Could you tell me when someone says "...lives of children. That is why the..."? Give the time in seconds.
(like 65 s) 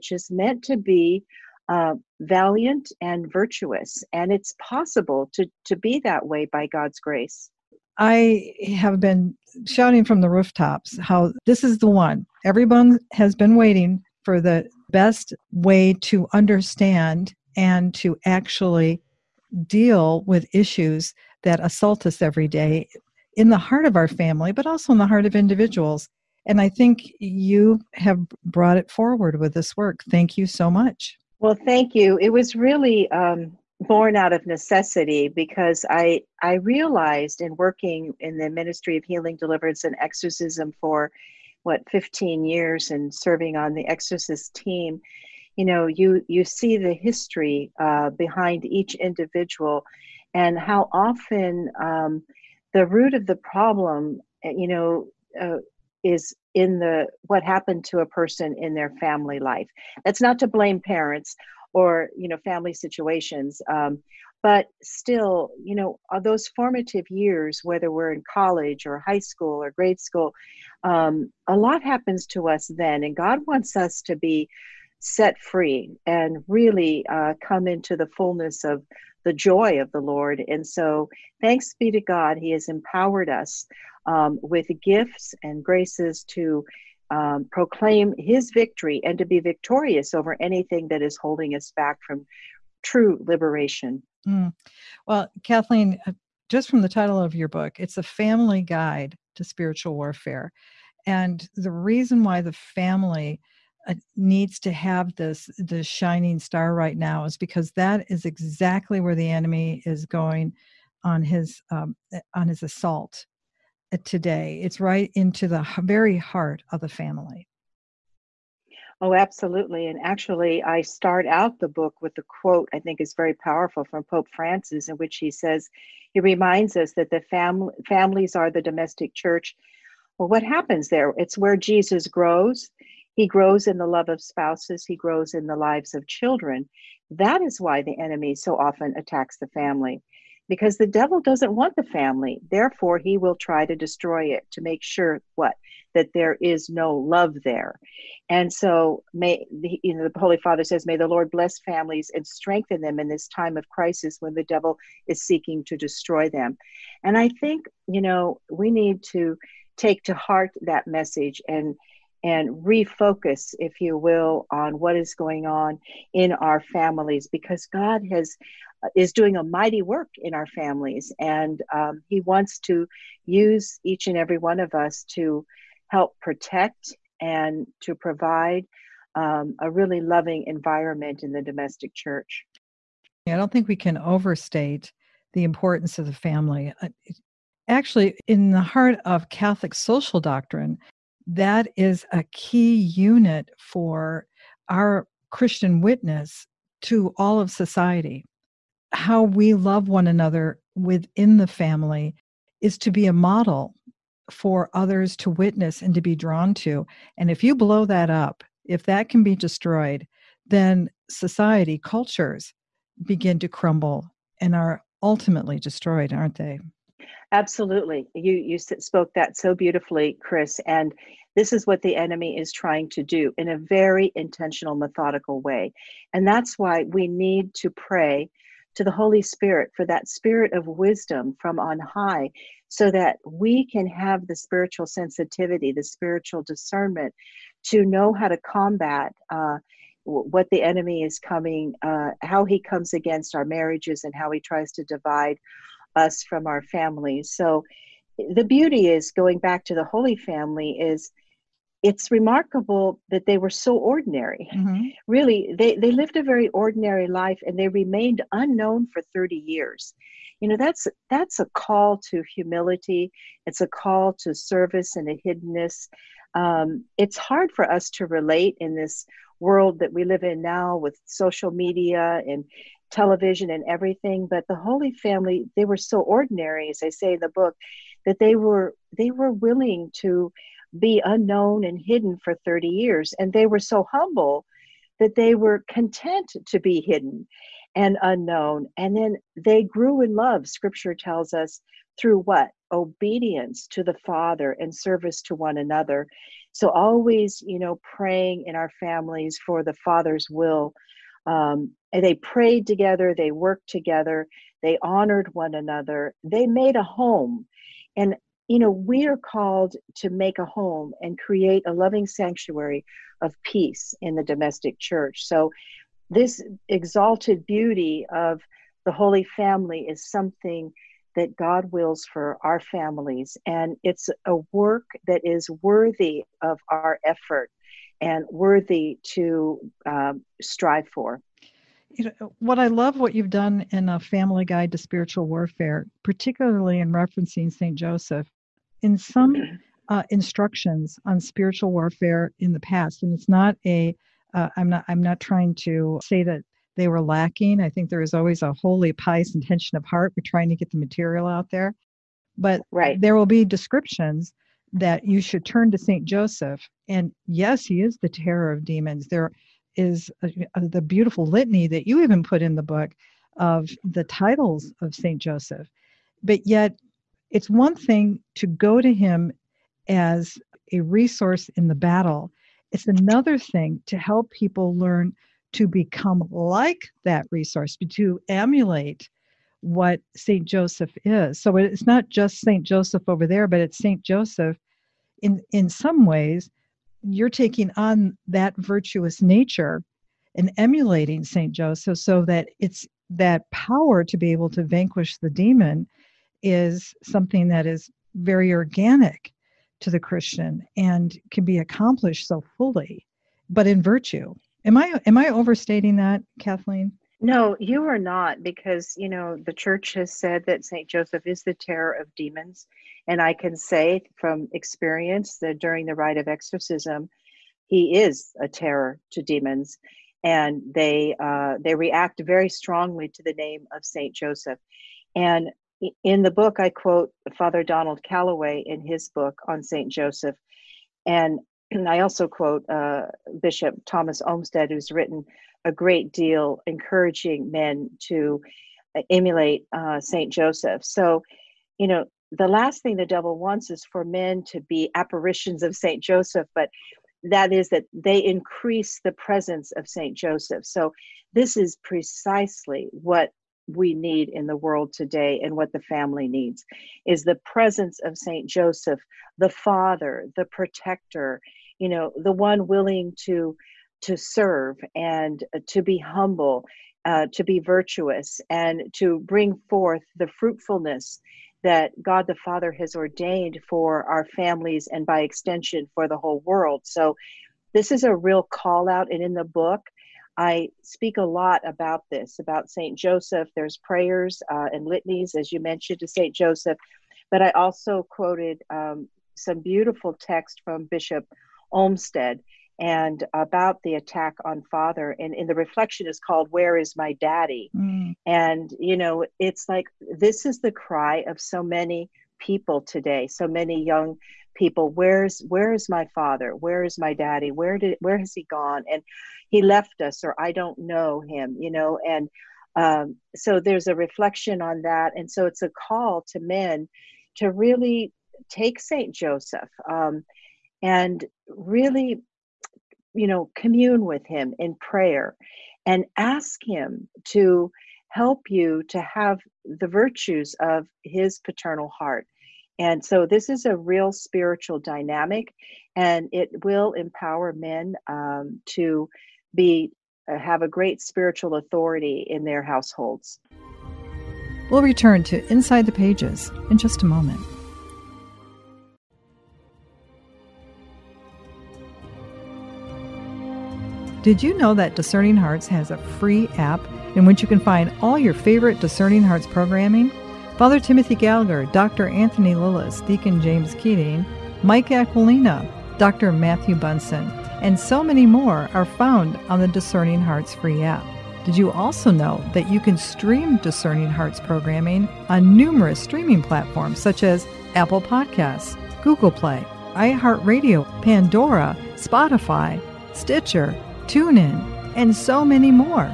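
135 s.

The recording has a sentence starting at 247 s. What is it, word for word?
So the beauty is going back to the Holy Family is it's remarkable that they were so ordinary.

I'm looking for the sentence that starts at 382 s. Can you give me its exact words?
Joseph over there, but it's St.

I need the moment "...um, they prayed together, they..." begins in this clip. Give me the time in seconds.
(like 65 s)
301 s.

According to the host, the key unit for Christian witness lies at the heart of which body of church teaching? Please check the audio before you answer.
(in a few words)
Catholic social doctrine.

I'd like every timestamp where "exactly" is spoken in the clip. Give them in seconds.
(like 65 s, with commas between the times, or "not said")
108 s.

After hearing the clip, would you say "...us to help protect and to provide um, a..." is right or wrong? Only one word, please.
right.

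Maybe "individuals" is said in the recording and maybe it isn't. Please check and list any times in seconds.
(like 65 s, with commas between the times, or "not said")
25 s, 48 s.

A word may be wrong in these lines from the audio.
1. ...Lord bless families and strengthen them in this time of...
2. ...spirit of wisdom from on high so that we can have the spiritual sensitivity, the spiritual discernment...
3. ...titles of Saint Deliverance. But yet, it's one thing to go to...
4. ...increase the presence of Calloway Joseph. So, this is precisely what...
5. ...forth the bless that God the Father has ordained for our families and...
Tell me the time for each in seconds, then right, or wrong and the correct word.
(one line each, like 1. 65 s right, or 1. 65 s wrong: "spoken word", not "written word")
1. 151 s right
2. 230 s right
3. 364 s wrong: "Joseph", not "Deliverance"
4. 448 s wrong: "Saint", not "Calloway"
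5. 469 s wrong: "fruitfulness", not "bless".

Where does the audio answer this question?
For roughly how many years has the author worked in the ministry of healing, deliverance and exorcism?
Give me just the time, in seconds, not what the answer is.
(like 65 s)
41 s.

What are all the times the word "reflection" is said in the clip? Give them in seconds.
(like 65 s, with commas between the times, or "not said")
495 s, 513 s.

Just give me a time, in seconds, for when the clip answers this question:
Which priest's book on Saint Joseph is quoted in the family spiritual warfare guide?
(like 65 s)
427 s.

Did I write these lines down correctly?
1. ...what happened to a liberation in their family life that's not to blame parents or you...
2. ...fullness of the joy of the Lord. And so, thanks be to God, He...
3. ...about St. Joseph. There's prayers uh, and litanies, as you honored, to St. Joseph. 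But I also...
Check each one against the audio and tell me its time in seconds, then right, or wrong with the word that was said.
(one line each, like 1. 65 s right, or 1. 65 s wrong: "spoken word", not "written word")
1. 57 s wrong: "person", not "liberation"
2. 78 s right
3. 482 s wrong: "mentioned", not "honored".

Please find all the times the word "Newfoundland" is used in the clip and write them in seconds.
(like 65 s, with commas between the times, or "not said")
not said.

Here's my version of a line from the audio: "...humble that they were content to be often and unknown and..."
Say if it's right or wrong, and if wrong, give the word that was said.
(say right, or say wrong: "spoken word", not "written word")
wrong: "hidden", not "often".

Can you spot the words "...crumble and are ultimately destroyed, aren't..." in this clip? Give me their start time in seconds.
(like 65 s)
213 s.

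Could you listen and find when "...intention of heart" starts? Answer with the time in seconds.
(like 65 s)
349 s.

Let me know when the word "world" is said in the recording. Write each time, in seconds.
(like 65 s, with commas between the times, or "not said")
269 s, 454 s, 476 s.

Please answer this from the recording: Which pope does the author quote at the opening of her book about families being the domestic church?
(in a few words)
Pope Francis.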